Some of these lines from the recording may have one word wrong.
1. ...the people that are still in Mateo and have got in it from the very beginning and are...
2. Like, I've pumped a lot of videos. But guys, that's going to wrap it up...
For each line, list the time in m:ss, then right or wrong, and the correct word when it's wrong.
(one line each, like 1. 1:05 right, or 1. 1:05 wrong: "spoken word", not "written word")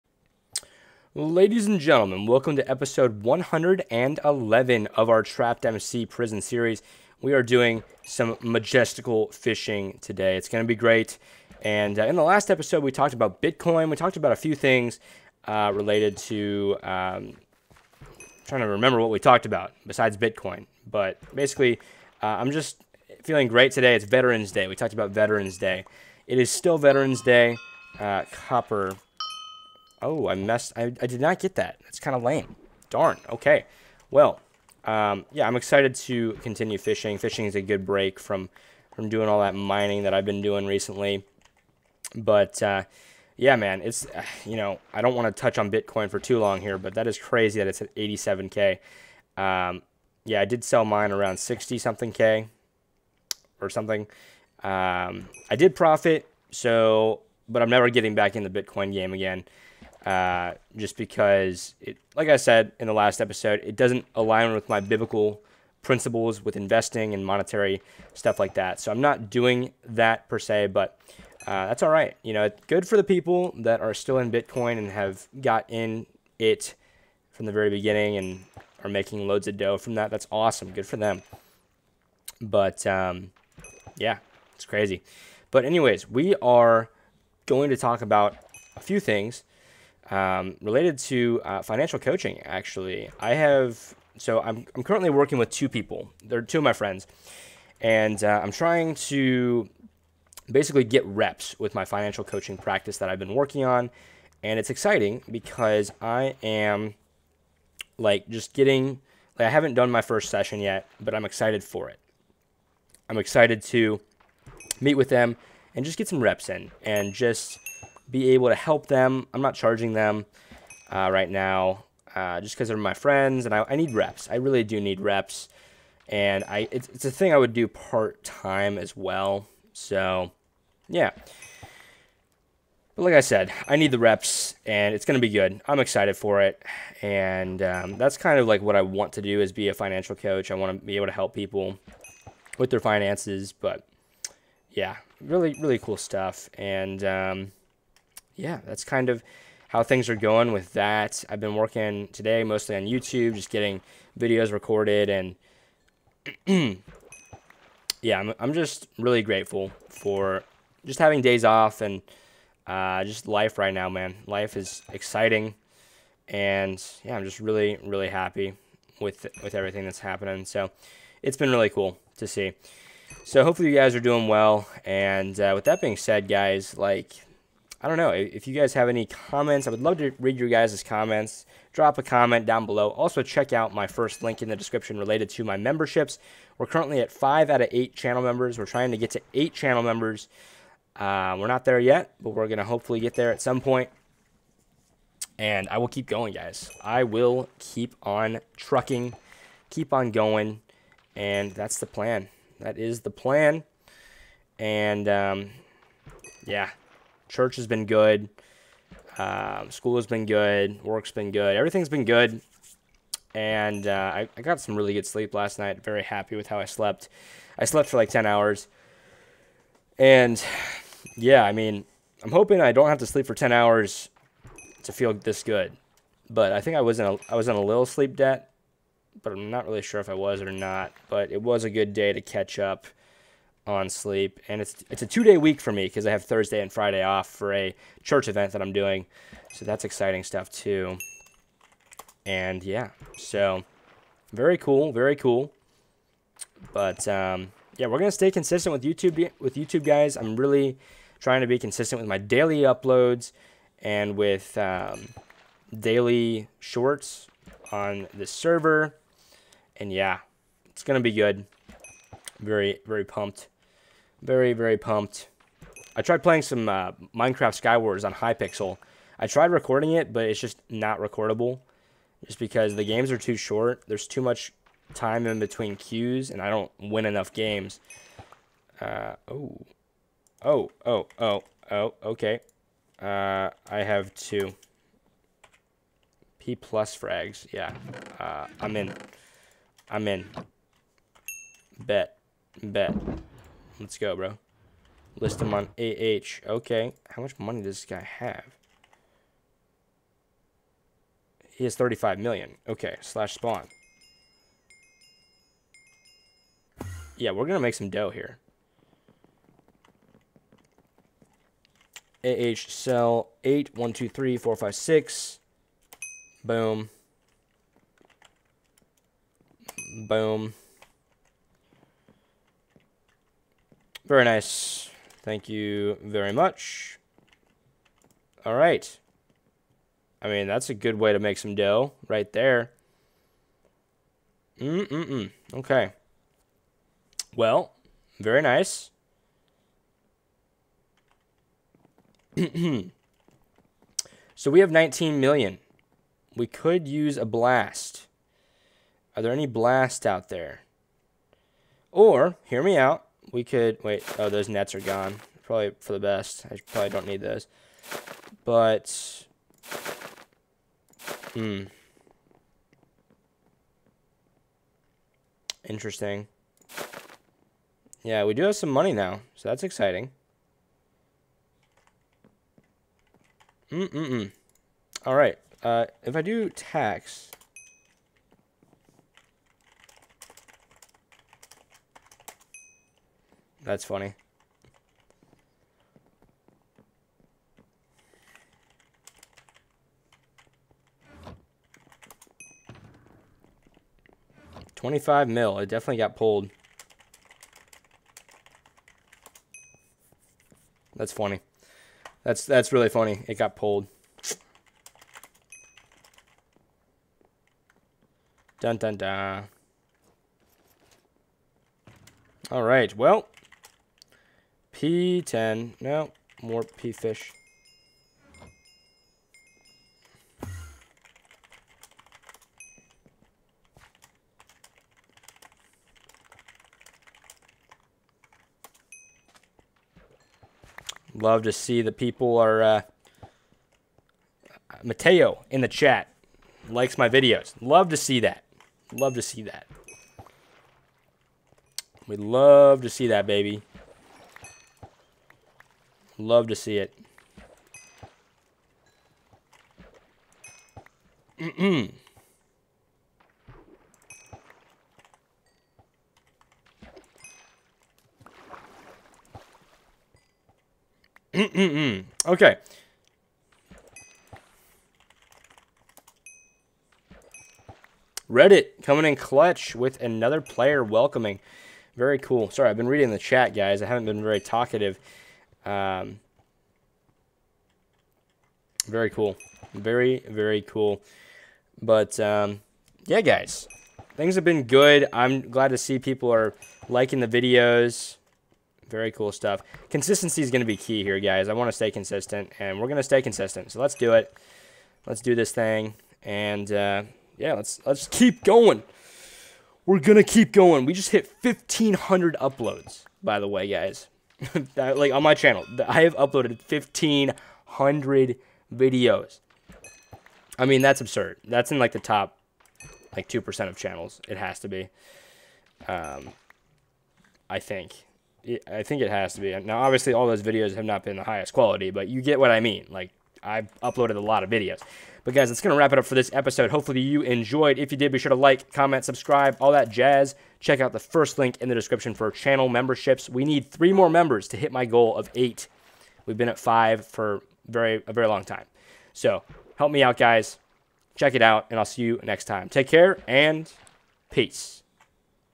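1. 1:12 wrong: "Bitcoin", not "Mateo"
2. 8:42 wrong: "uploaded", not "pumped".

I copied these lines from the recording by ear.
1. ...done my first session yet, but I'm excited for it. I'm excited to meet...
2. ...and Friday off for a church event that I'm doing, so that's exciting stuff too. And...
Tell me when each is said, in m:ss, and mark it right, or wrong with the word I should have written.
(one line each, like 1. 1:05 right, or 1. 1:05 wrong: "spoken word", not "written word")
1. 1:49 right
2. 3:56 right.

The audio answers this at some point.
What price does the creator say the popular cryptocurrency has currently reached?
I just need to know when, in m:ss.
0:47.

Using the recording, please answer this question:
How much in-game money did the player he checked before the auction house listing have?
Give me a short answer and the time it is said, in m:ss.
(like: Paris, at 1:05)
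35 million, at 5:01.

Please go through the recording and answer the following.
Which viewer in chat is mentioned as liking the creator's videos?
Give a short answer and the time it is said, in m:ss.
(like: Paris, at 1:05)
Mateo, at 7:14.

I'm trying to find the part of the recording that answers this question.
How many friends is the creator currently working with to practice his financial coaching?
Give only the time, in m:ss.
1:35.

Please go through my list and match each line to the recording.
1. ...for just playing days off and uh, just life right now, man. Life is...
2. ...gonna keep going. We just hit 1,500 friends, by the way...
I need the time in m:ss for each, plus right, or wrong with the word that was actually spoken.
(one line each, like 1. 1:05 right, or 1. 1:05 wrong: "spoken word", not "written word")
1. 2:39 wrong: "having", not "playing"
2. 8:19 wrong: "uploads", not "friends".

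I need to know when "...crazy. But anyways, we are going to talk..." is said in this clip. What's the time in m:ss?
1:24.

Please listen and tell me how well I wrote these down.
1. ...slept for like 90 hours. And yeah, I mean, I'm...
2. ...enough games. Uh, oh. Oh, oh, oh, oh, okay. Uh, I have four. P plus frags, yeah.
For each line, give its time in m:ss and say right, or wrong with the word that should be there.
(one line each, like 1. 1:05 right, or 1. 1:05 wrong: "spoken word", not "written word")
1. 3:37 wrong: "10", not "90"
2. 4:37 wrong: "two", not "four".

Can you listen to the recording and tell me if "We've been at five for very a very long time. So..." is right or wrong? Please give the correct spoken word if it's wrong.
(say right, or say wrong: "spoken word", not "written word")
right.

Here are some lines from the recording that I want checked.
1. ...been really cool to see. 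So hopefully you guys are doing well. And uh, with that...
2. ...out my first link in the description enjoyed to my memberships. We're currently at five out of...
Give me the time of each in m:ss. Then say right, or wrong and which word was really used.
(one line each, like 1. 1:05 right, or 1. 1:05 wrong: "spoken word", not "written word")
1. 2:51 right
2. 3:03 wrong: "related", not "enjoyed".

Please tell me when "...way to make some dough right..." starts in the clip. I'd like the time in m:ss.
5:30.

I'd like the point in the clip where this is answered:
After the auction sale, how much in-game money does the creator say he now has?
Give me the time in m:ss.
5:44.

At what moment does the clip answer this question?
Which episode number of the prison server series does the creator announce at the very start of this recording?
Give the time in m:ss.
0:02.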